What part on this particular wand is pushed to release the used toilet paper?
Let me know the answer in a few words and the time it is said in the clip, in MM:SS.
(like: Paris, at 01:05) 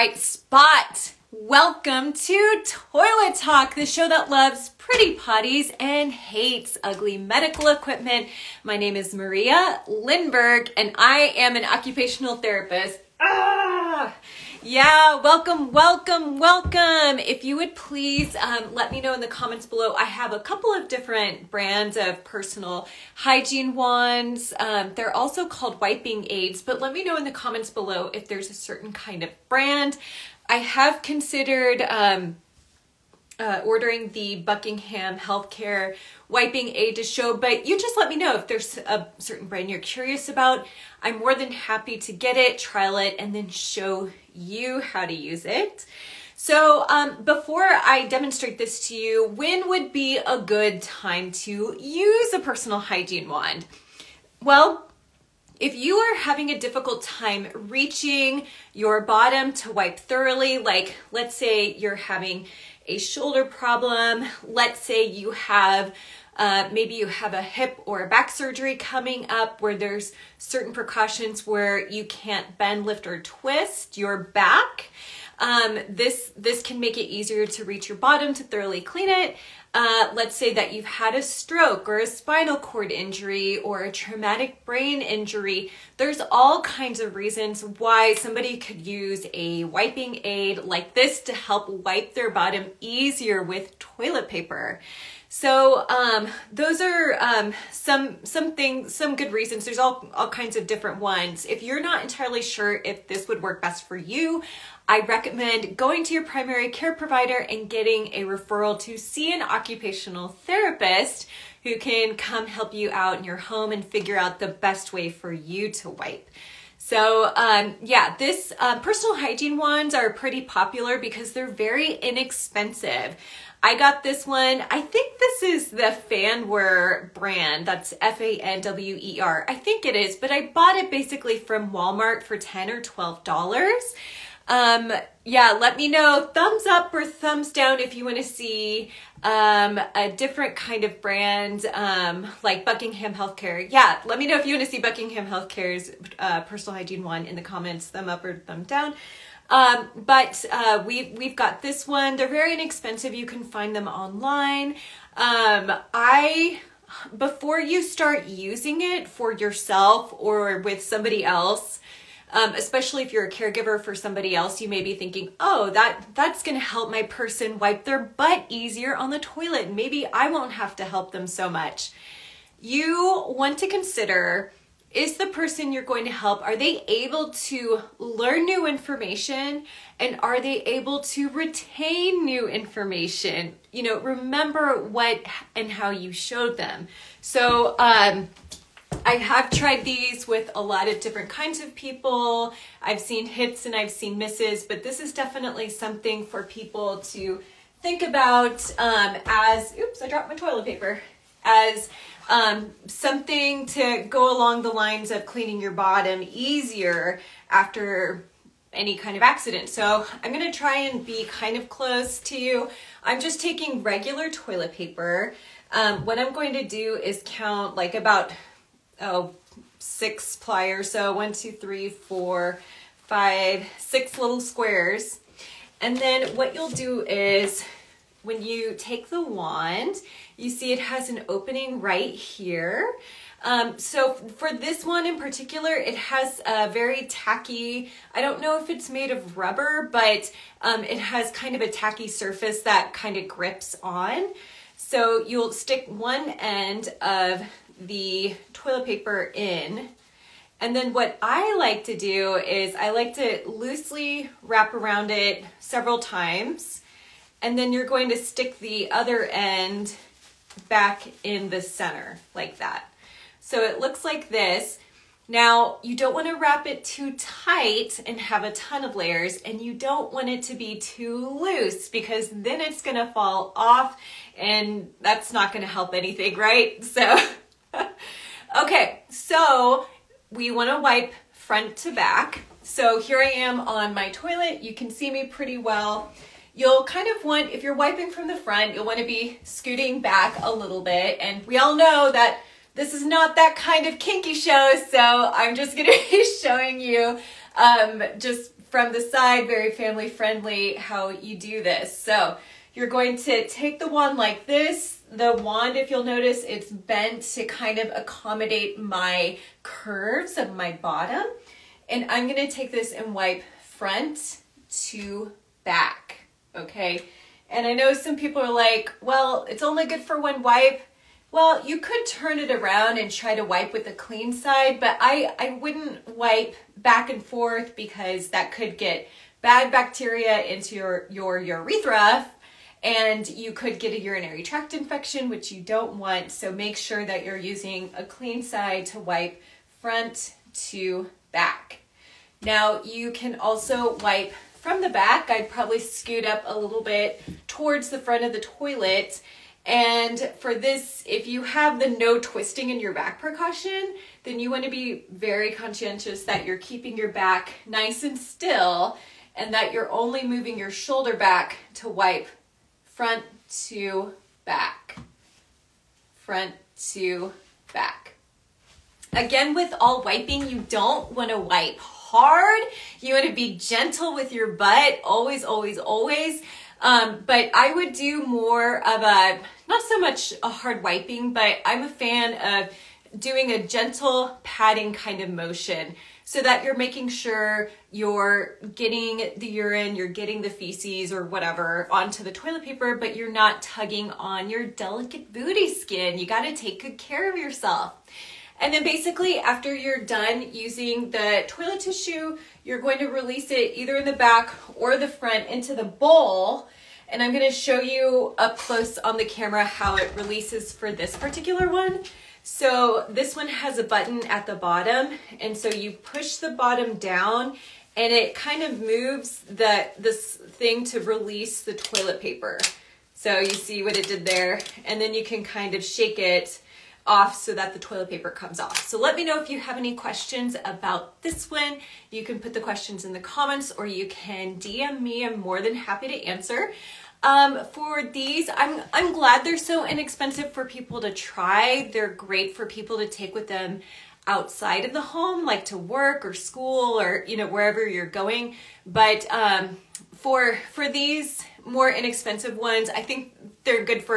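a button, at 06:53.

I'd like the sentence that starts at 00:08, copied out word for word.
My name is Maria Lindberg and I am an occupational therapist.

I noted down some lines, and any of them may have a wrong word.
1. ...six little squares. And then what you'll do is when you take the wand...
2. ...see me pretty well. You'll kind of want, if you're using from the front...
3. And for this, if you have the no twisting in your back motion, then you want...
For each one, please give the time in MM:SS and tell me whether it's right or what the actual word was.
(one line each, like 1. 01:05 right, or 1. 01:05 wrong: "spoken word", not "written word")
1. 03:43 right
2. 04:44 wrong: "wiping", not "using"
3. 05:49 wrong: "precaution", not "motion".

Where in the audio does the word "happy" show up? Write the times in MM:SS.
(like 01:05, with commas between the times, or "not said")
00:41, 07:15.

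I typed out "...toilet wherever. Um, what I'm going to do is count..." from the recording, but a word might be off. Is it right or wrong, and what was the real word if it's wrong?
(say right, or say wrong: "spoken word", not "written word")
wrong: "paper", not "wherever".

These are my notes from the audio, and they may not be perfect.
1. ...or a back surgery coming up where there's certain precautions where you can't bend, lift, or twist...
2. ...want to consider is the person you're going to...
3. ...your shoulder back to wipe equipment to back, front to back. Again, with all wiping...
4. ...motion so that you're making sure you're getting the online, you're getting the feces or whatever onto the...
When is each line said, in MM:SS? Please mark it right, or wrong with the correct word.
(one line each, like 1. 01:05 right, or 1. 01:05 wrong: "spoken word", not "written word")
1. 01:07 right
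2. 02:53 right
3. 06:00 wrong: "front", not "equipment"
4. 06:25 wrong: "urine", not "online".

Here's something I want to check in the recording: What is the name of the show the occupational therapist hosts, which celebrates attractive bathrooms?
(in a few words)
Toilet Talk.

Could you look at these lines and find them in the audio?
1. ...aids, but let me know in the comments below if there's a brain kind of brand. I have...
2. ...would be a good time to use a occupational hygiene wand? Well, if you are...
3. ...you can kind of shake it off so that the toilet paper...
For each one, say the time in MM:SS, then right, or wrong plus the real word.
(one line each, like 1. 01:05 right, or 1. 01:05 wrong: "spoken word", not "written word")
1. 00:26 wrong: "certain", not "brain"
2. 00:49 wrong: "personal", not "occupational"
3. 07:05 right.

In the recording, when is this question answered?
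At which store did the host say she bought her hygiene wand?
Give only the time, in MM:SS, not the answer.
02:11.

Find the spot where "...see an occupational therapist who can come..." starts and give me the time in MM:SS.
01:48.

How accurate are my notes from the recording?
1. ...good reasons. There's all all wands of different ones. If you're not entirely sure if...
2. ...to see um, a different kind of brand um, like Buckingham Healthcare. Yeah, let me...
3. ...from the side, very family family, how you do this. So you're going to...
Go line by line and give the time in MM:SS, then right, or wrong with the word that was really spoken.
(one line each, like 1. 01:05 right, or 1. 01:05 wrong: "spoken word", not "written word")
1. 01:39 wrong: "kinds", not "wands"
2. 02:18 right
3. 04:58 wrong: "friendly", not "family".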